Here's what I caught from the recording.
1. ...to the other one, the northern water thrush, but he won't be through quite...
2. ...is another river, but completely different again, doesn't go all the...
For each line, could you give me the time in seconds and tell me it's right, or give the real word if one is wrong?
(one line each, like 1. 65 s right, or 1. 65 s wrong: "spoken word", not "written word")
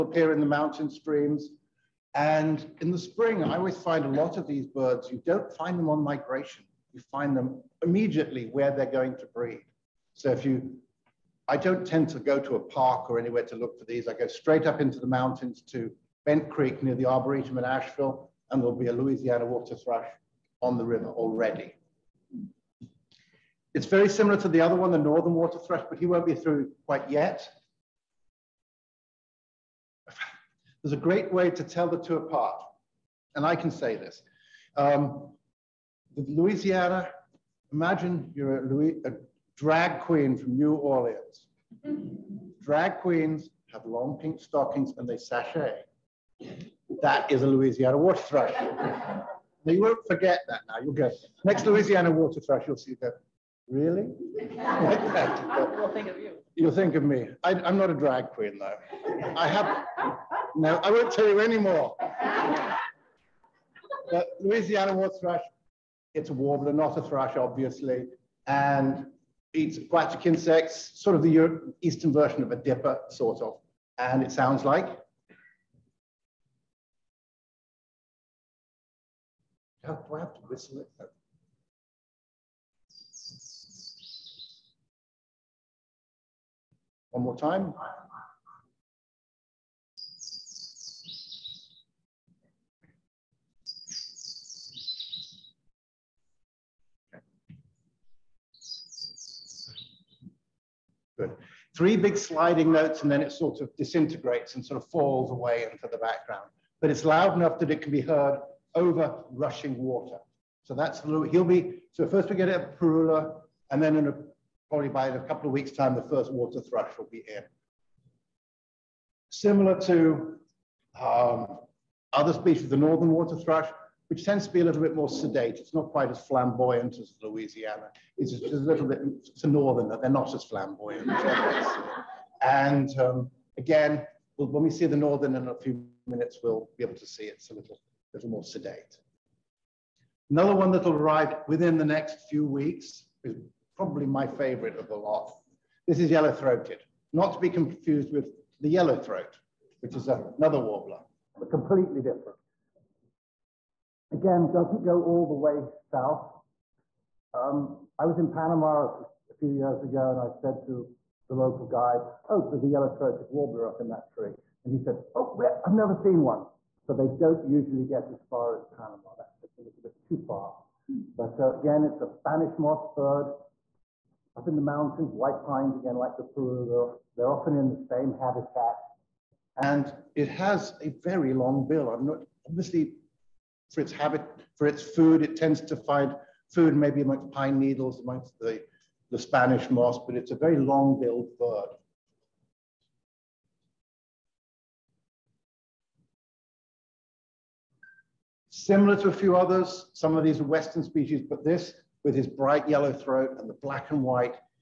1. 24 s right
2. 149 s wrong: "warbler", not "river".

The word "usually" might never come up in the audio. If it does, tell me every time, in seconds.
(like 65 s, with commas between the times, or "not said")
167 s.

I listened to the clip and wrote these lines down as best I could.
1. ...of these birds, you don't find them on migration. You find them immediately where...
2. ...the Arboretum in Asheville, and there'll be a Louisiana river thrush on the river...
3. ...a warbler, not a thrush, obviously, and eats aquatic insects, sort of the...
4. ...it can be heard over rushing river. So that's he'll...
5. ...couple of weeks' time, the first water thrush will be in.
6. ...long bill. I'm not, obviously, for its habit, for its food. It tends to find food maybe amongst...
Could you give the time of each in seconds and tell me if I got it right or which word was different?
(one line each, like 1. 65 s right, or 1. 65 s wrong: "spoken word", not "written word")
1. 4 s right
2. 16 s wrong: "water", not "river"
3. 66 s right
4. 107 s wrong: "water", not "river"
5. 115 s right
6. 181 s right.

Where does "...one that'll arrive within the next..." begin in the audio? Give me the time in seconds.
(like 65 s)
140 s.